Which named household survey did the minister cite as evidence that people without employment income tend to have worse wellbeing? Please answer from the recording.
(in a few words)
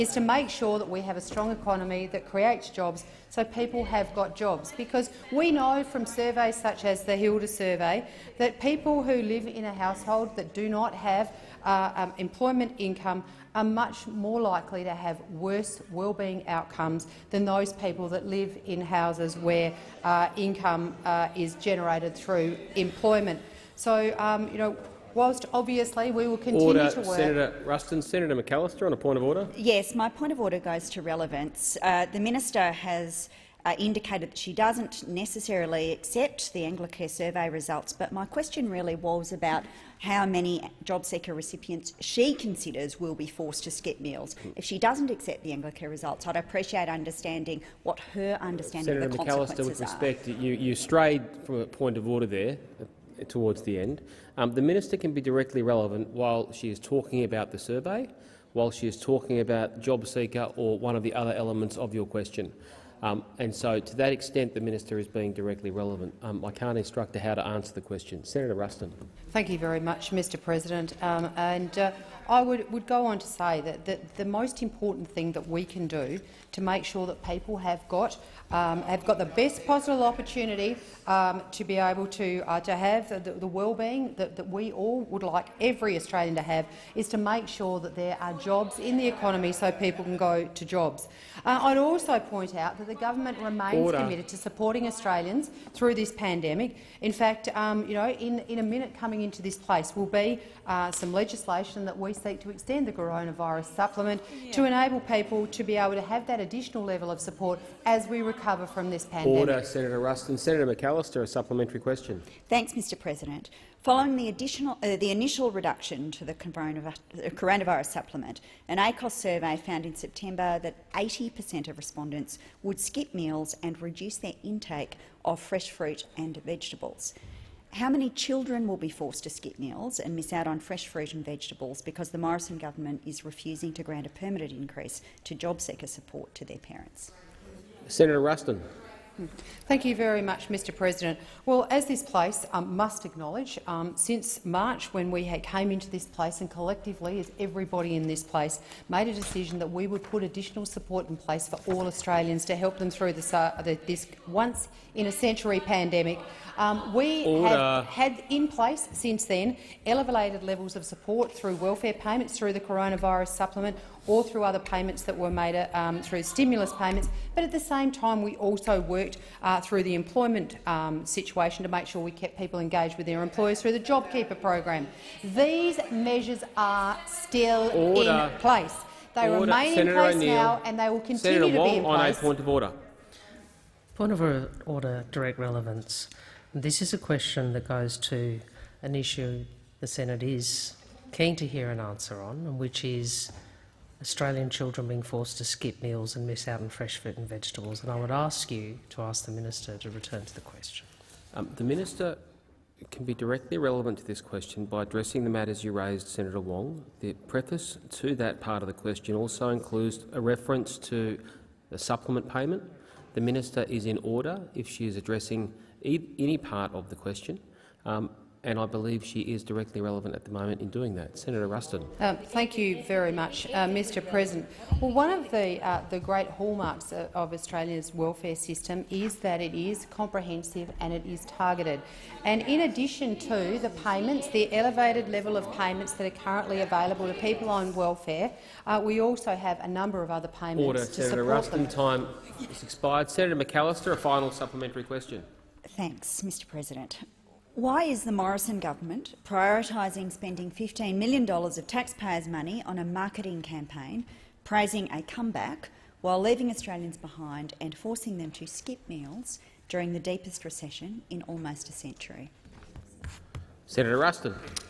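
Hilda survey.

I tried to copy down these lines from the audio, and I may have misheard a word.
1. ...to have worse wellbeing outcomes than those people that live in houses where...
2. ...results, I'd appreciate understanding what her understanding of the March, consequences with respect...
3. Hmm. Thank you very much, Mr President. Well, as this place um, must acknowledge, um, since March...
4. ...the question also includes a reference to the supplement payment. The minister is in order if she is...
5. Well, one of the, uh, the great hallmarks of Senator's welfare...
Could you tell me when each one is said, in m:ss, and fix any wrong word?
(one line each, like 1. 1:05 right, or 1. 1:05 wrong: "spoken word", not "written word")
1. 0:14 right
2. 0:45 wrong: "McAllister", not "March"
3. 2:19 right
4. 3:28 right
5. 3:44 wrong: "Australia", not "Senator".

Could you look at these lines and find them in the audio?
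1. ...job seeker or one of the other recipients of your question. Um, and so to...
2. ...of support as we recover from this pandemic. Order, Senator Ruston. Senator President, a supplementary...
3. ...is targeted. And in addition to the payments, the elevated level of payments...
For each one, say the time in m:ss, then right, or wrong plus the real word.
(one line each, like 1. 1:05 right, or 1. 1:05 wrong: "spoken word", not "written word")
1. 0:59 wrong: "elements", not "recipients"
2. 1:47 wrong: "McAllister", not "President"
3. 3:51 right.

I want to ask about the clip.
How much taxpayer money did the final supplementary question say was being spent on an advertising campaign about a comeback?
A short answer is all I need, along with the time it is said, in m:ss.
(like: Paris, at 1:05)
$15 million, at 4:10.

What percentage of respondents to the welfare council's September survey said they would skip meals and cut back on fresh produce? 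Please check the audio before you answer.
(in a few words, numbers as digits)
80 per cent.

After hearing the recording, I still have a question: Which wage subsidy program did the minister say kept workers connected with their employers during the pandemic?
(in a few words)
JobKeeper.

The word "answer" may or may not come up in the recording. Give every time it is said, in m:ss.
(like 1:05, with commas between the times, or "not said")
1:07, 3:11.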